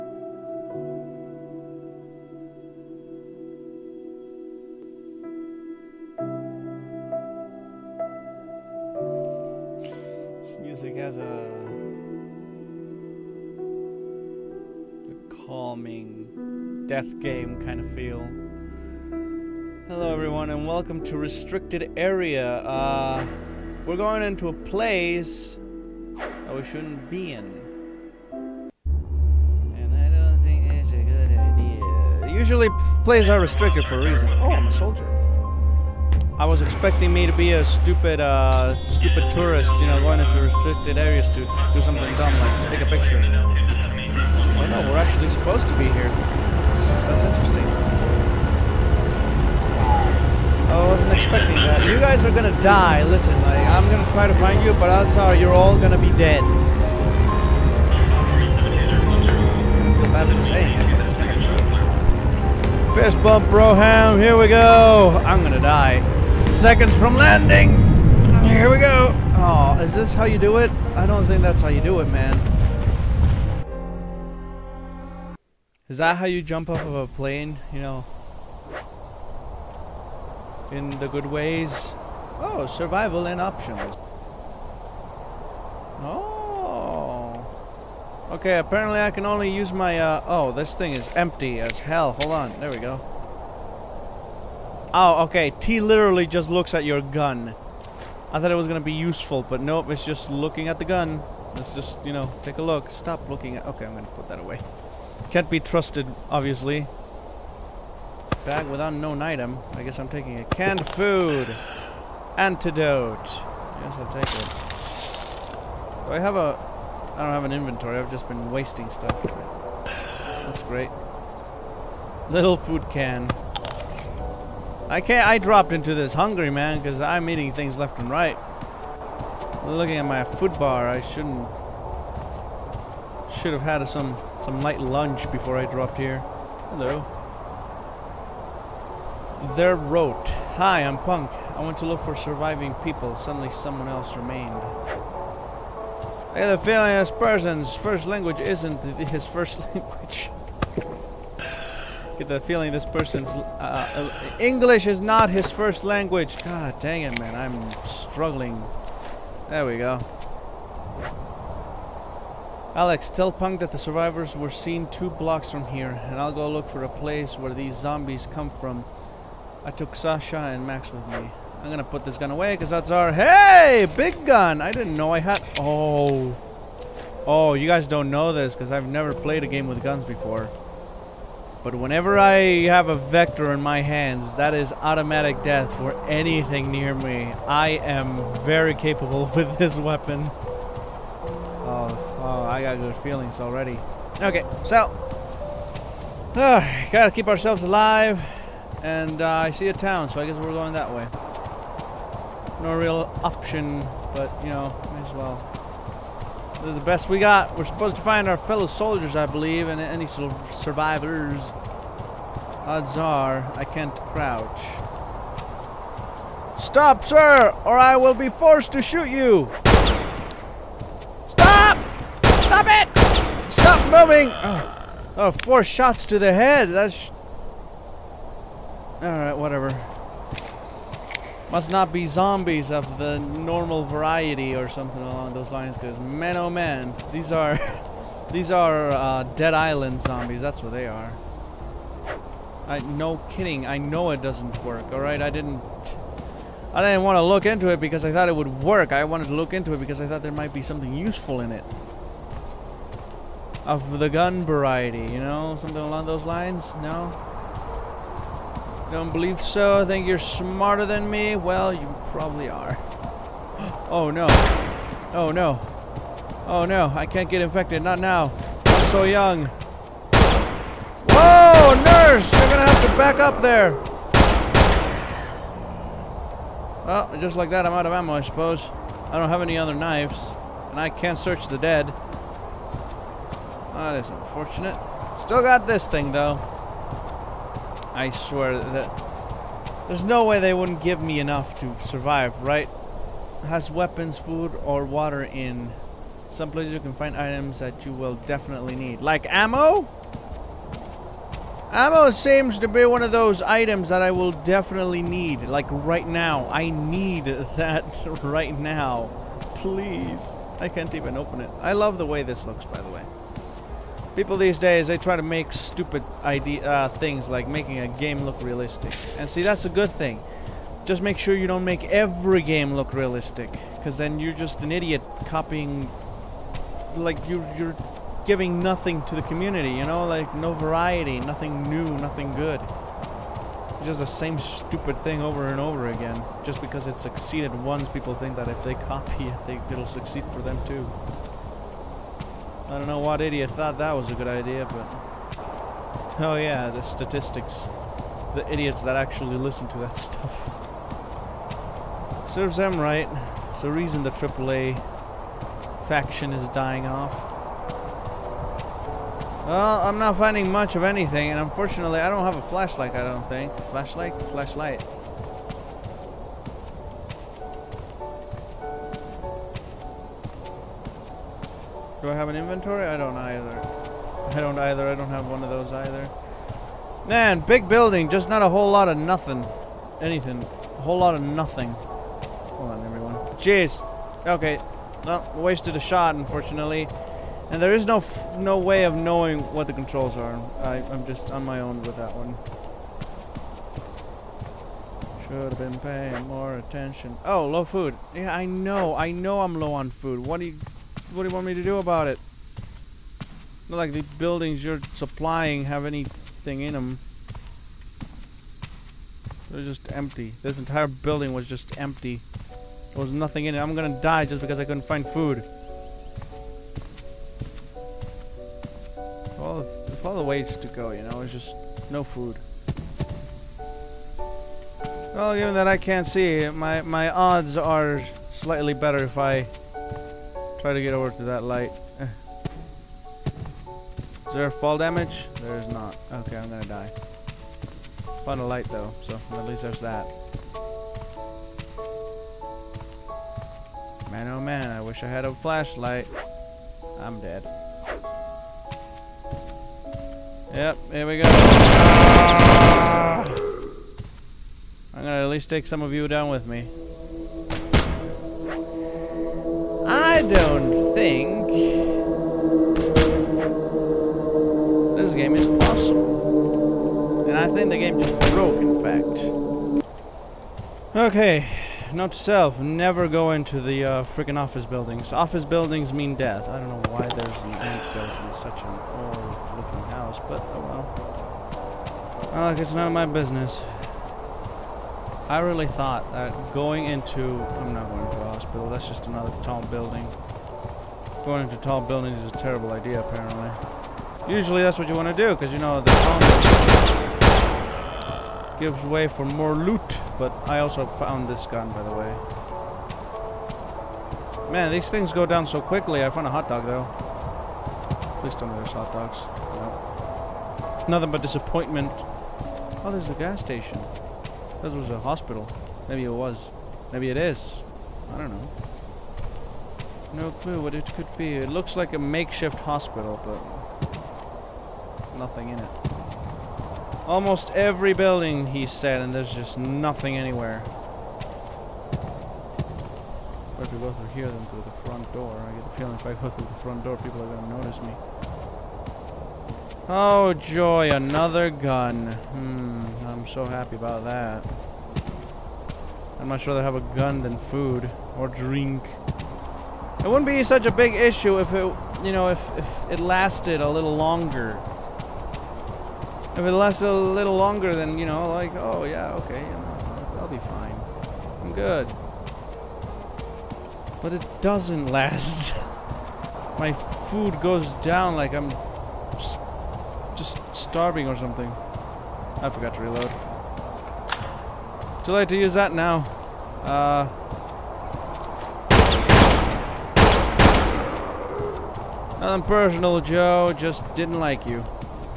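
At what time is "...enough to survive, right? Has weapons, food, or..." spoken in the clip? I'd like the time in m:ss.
4:51.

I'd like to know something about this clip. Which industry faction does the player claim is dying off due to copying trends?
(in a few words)
AAA.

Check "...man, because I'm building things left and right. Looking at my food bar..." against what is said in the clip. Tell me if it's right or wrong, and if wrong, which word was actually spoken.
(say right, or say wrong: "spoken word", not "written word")
wrong: "eating", not "building".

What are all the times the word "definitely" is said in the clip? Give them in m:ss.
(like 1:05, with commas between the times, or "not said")
4:58, 5:04.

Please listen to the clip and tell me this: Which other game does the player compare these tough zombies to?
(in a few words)
Dead Island.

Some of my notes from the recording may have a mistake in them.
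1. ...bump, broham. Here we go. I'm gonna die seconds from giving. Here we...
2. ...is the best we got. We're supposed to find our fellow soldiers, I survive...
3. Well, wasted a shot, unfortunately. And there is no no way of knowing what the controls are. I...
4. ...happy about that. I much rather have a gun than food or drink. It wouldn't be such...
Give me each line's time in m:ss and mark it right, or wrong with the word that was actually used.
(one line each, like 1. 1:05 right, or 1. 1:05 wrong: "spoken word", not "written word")
1. 1:03 wrong: "landing", not "giving"
2. 3:26 wrong: "believe", not "survive"
3. 6:25 right
4. 9:03 right.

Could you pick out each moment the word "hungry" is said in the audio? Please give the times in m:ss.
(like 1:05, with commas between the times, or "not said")
2:06.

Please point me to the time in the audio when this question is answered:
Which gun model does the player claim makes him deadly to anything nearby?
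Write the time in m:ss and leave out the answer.
3:02.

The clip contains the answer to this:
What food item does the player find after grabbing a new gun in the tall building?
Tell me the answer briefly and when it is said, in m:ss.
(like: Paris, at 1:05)
Hot dog, at 8:26.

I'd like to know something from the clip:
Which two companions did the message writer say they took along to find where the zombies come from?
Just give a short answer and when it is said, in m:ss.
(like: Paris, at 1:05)
Sasha and Max, at 2:49.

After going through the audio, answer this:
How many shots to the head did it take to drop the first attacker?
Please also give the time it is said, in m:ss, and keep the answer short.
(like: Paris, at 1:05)
4, at 3:45.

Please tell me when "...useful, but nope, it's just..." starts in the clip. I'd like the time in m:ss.
1:38.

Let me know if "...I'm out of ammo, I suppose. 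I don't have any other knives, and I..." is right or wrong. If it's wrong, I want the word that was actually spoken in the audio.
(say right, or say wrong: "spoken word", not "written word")
right.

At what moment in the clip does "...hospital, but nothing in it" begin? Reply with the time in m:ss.
8:42.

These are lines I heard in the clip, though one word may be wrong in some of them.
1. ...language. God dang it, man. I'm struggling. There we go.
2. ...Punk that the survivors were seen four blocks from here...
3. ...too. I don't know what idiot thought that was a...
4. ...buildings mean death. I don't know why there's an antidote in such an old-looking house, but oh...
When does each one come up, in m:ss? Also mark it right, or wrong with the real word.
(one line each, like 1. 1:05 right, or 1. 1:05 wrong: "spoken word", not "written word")
1. 2:35 right
2. 2:43 wrong: "two", not "four"
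3. 5:40 right
4. 7:55 right.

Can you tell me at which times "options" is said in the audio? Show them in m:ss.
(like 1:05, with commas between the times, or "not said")
1:23, 3:23.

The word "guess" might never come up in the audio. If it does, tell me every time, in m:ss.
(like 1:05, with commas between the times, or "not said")
1:49, 3:20.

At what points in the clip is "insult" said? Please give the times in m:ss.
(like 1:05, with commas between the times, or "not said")
not said.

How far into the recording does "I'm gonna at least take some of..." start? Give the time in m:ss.
7:34.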